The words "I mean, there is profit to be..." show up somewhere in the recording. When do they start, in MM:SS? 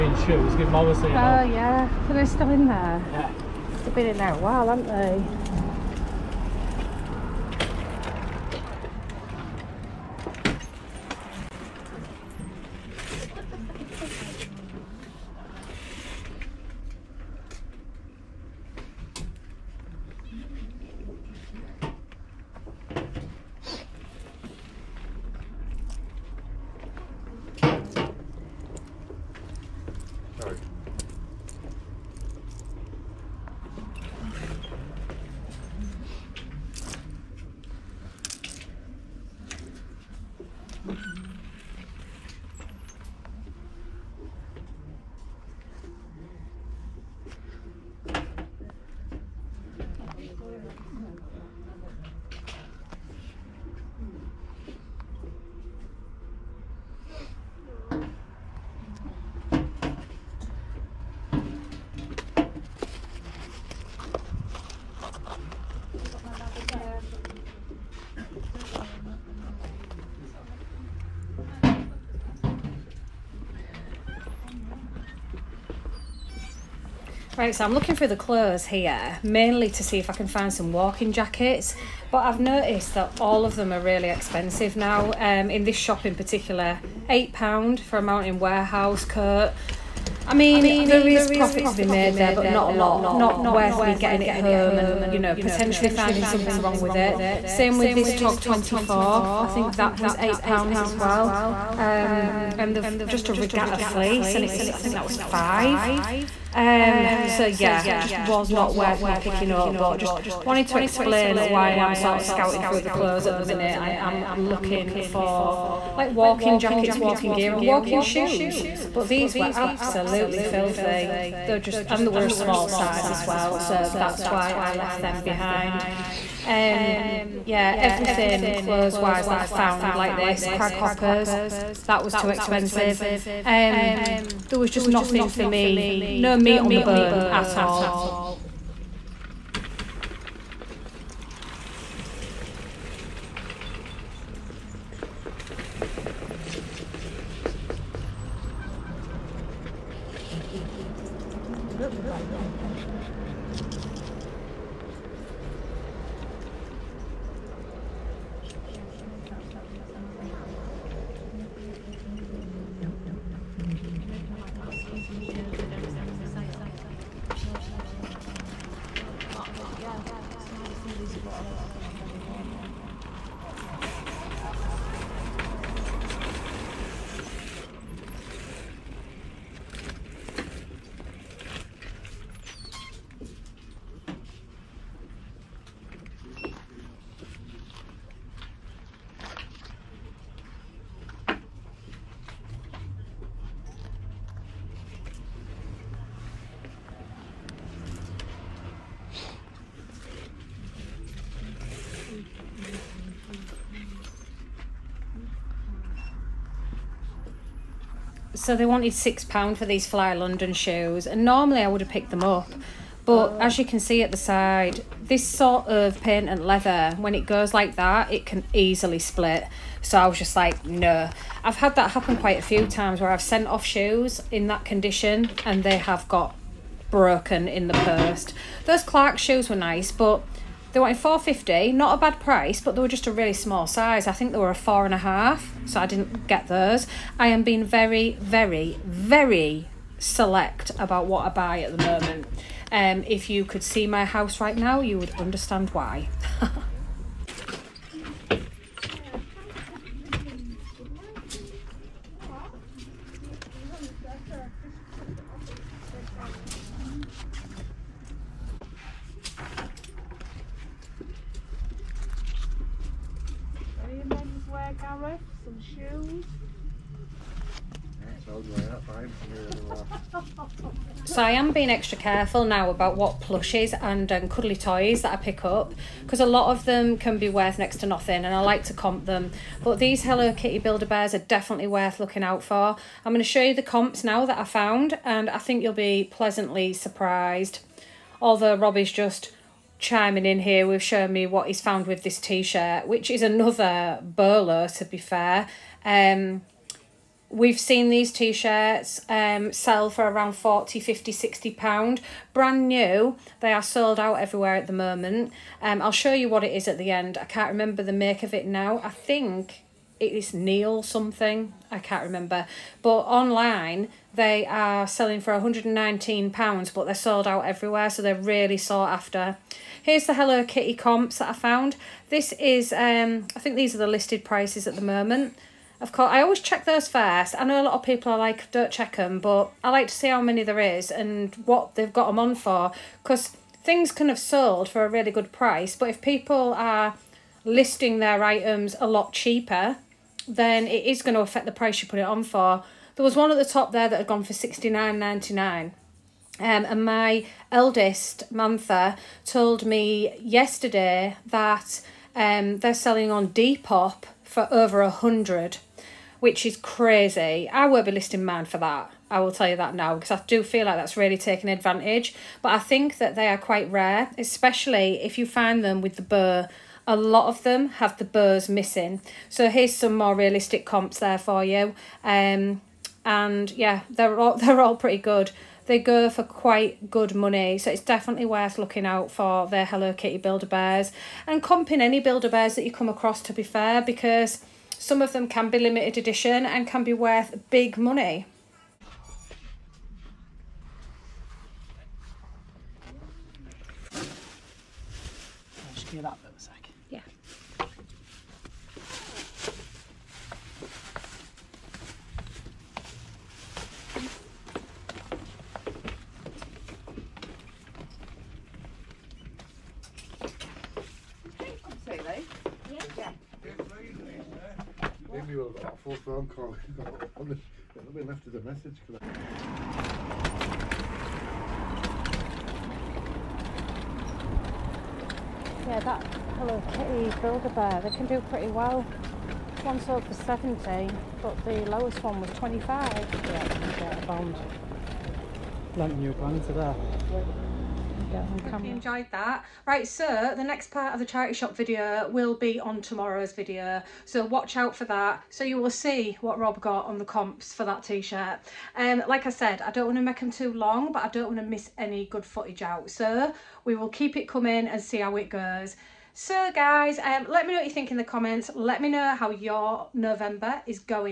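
01:30.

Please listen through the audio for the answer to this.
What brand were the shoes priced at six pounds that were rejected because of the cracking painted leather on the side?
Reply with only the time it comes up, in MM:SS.
03:29.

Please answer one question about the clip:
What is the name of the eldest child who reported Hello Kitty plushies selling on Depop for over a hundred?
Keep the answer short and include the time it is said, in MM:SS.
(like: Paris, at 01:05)
Mantha, at 05:48.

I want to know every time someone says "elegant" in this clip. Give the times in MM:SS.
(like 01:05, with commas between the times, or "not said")
not said.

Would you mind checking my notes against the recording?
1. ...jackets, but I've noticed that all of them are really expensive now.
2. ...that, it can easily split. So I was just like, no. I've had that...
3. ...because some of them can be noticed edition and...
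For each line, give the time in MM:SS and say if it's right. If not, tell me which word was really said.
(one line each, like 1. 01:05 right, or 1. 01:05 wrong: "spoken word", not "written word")
1. 01:21 right
2. 03:37 right
3. 06:23 wrong: "limited", not "noticed".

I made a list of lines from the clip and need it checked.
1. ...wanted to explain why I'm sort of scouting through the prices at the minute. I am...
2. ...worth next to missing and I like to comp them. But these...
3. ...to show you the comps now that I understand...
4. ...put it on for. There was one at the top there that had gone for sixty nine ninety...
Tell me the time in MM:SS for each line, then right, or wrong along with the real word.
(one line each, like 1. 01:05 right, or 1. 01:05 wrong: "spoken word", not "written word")
1. 01:50 wrong: "clothes", not "prices"
2. 04:37 wrong: "nothing", not "missing"
3. 04:43 wrong: "found", not "understand"
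4. 05:41 right.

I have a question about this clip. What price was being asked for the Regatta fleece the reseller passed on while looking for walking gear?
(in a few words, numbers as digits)
£5.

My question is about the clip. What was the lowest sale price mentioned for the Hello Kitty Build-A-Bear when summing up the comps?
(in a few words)
25.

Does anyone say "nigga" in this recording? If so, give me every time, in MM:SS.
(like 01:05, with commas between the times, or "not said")
not said.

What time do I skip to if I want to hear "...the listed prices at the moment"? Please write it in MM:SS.
05:23.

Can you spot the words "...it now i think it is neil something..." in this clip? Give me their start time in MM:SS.
05:08.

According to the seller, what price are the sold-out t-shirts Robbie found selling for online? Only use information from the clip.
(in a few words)
£119.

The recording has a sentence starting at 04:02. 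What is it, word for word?
Um, if you could see my house right now, you would understand why.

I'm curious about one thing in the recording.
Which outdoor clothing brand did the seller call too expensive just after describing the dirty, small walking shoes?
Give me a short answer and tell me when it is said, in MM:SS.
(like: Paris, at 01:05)
Craghoppers, at 02:10.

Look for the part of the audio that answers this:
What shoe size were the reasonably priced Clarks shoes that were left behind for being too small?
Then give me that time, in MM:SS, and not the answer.
03:54.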